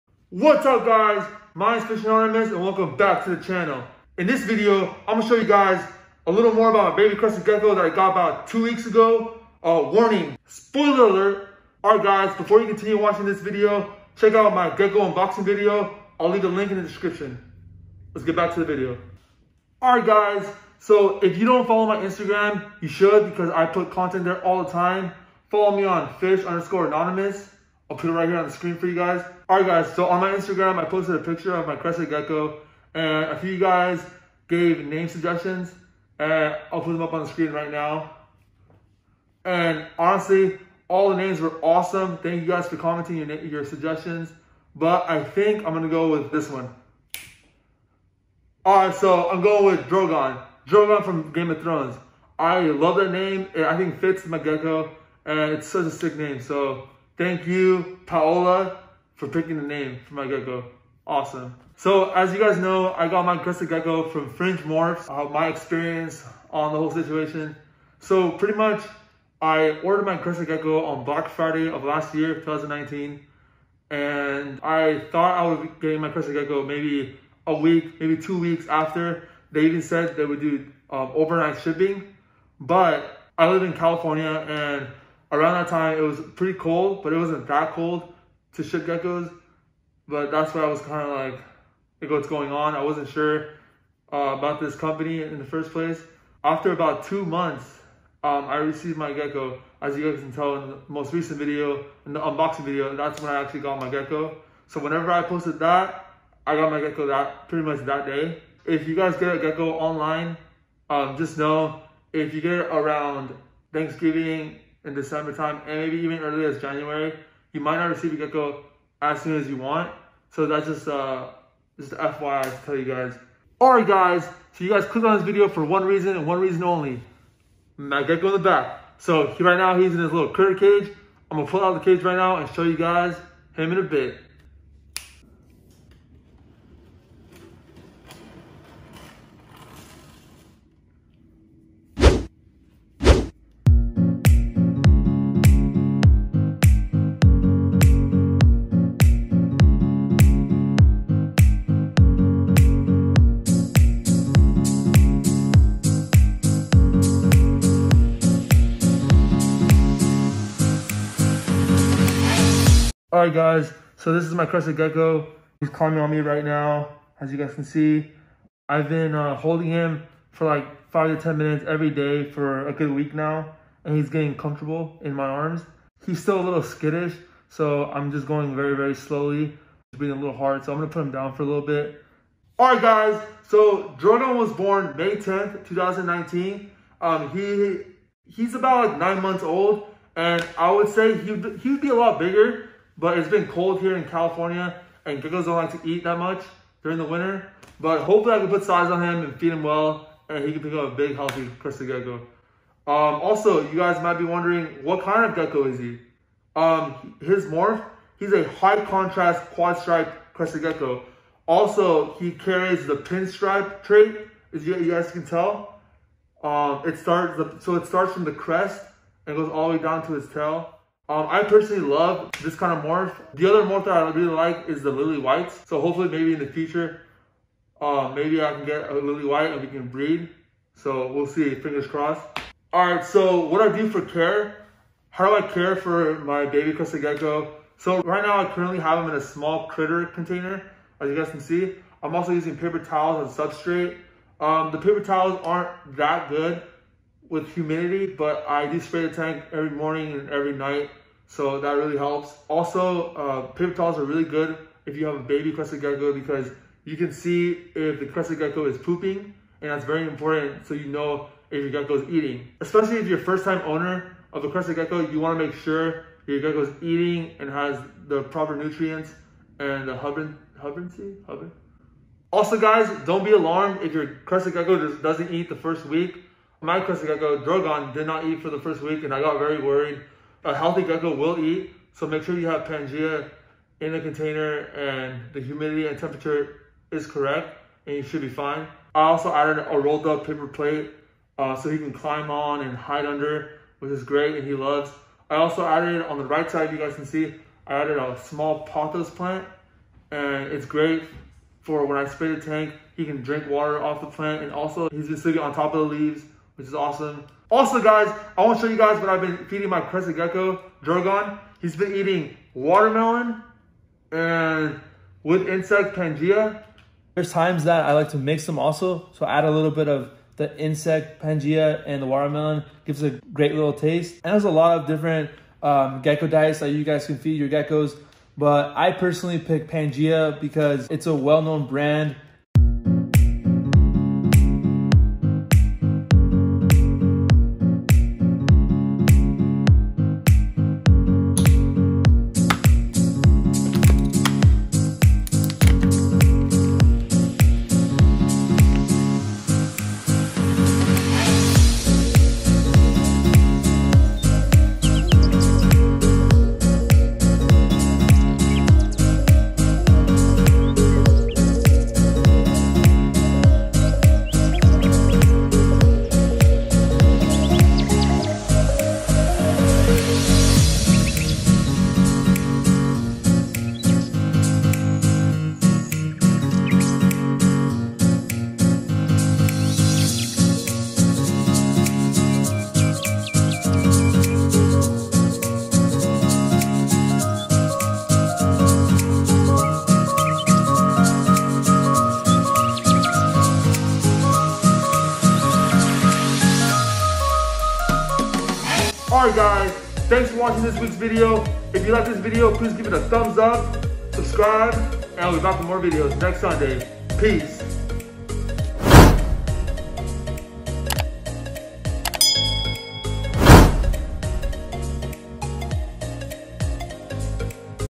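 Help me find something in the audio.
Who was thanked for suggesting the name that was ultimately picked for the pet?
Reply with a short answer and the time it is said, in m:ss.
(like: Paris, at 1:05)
Paola, at 0:58.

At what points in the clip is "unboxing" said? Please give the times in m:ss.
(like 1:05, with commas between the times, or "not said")
0:15, 1:42.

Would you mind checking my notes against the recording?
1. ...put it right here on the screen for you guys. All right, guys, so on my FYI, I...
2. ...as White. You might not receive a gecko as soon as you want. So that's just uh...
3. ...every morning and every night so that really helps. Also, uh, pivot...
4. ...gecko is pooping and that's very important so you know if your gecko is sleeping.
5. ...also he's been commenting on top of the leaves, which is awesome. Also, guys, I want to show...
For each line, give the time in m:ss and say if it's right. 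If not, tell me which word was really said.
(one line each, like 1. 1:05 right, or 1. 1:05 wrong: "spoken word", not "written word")
1. 0:27 wrong: "Instagram", not "FYI"
2. 1:56 wrong: "January", not "White"
3. 4:09 right
4. 4:18 wrong: "eating", not "sleeping"
5. 5:04 wrong: "sleeping", not "commenting".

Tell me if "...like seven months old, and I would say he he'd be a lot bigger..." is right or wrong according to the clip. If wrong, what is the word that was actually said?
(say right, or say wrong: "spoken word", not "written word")
wrong: "nine", not "seven".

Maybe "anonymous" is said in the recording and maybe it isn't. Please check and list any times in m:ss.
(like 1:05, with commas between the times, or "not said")
0:02, 0:26.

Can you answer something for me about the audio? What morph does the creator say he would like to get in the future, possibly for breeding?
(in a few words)
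Lilly White.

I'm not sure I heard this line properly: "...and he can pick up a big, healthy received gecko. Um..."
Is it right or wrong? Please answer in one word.
wrong.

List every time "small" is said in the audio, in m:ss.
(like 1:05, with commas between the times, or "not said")
3:59, 4:58.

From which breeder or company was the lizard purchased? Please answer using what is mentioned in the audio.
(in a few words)
Fringe Morphs.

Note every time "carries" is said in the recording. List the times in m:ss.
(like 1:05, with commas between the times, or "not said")
3:32.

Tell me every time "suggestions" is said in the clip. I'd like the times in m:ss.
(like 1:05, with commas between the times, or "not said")
0:35, 0:43.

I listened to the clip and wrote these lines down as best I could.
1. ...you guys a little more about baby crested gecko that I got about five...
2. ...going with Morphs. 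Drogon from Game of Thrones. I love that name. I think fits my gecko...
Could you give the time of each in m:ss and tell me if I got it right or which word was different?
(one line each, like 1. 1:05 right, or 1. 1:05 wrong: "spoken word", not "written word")
1. 0:05 wrong: "two", not "five"
2. 0:49 wrong: "Drogon", not "Morphs".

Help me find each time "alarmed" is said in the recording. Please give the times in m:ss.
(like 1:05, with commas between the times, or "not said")
4:33.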